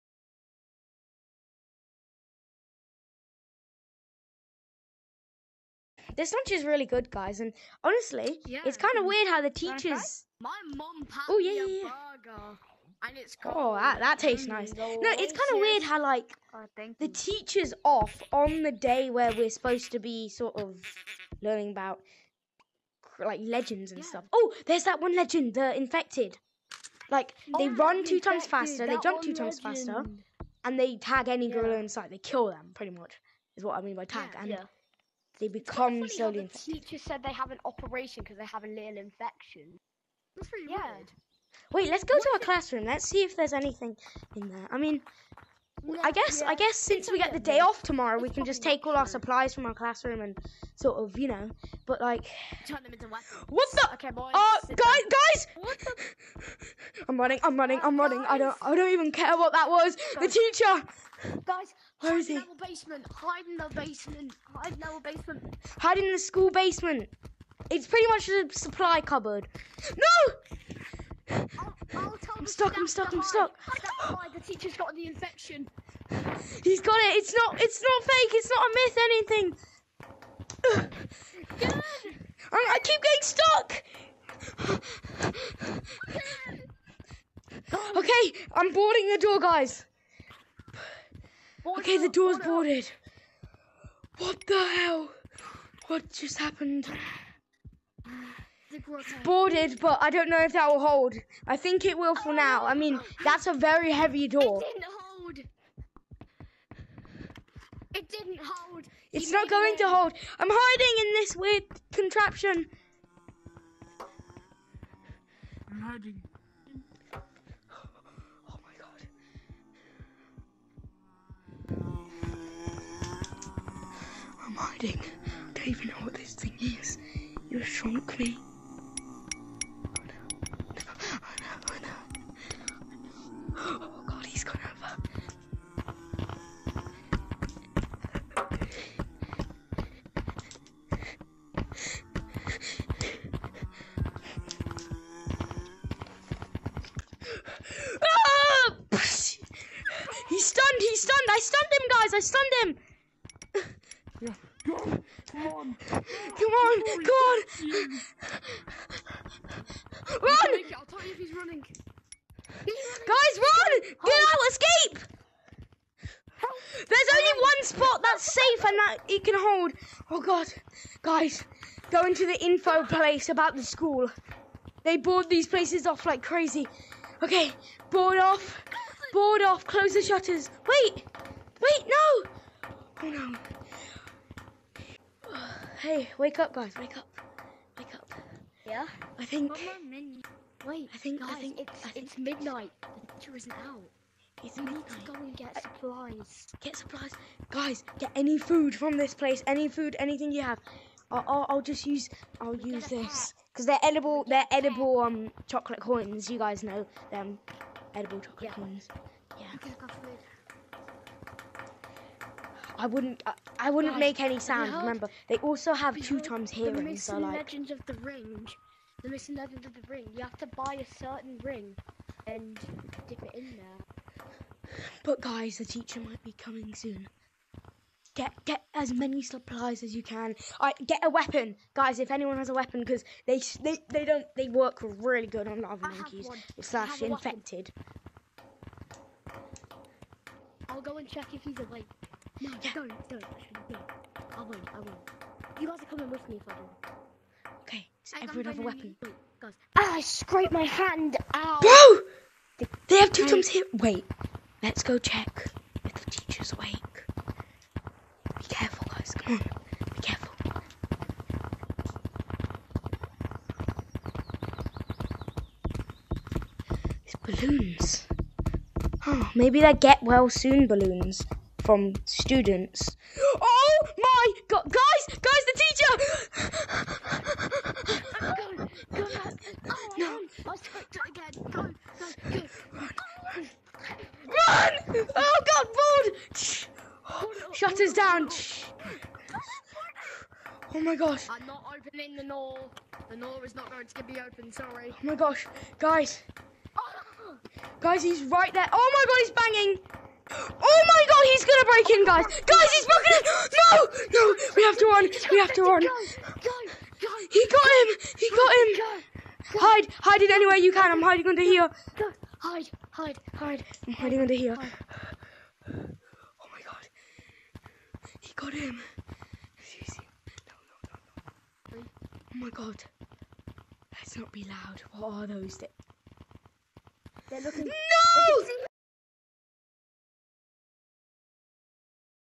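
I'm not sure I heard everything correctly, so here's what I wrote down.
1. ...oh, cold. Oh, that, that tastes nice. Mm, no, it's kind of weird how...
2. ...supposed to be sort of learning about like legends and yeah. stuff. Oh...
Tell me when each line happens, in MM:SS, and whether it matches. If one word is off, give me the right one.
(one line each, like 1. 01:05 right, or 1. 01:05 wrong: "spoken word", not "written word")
1. 00:13 right
2. 00:19 right.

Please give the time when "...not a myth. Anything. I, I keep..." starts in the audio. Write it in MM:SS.
01:18.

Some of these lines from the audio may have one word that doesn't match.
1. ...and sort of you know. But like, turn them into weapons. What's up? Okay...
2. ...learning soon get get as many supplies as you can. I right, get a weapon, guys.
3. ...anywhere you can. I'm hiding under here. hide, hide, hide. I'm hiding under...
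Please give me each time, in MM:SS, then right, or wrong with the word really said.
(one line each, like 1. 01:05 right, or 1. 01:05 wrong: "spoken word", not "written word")
1. 00:50 right
2. 03:46 wrong: "coming", not "learning"
3. 05:10 right.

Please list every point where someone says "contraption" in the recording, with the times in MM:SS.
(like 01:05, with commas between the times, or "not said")
01:51.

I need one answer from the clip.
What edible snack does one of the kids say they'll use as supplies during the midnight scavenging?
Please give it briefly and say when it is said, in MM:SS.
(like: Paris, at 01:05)
Chocolate coins, at 03:25.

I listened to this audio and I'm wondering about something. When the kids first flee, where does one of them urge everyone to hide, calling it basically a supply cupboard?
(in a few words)
The school basement.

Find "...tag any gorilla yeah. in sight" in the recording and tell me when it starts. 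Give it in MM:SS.
00:30.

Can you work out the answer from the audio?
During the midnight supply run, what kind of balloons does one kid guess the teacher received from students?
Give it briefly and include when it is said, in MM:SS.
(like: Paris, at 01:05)
Get well soon balloons, at 04:29.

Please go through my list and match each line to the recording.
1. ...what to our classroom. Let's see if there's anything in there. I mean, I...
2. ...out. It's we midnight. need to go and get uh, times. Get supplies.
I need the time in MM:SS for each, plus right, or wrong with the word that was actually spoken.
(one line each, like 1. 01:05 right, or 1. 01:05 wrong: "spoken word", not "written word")
1. 00:42 right
2. 03:13 wrong: "supplies", not "times".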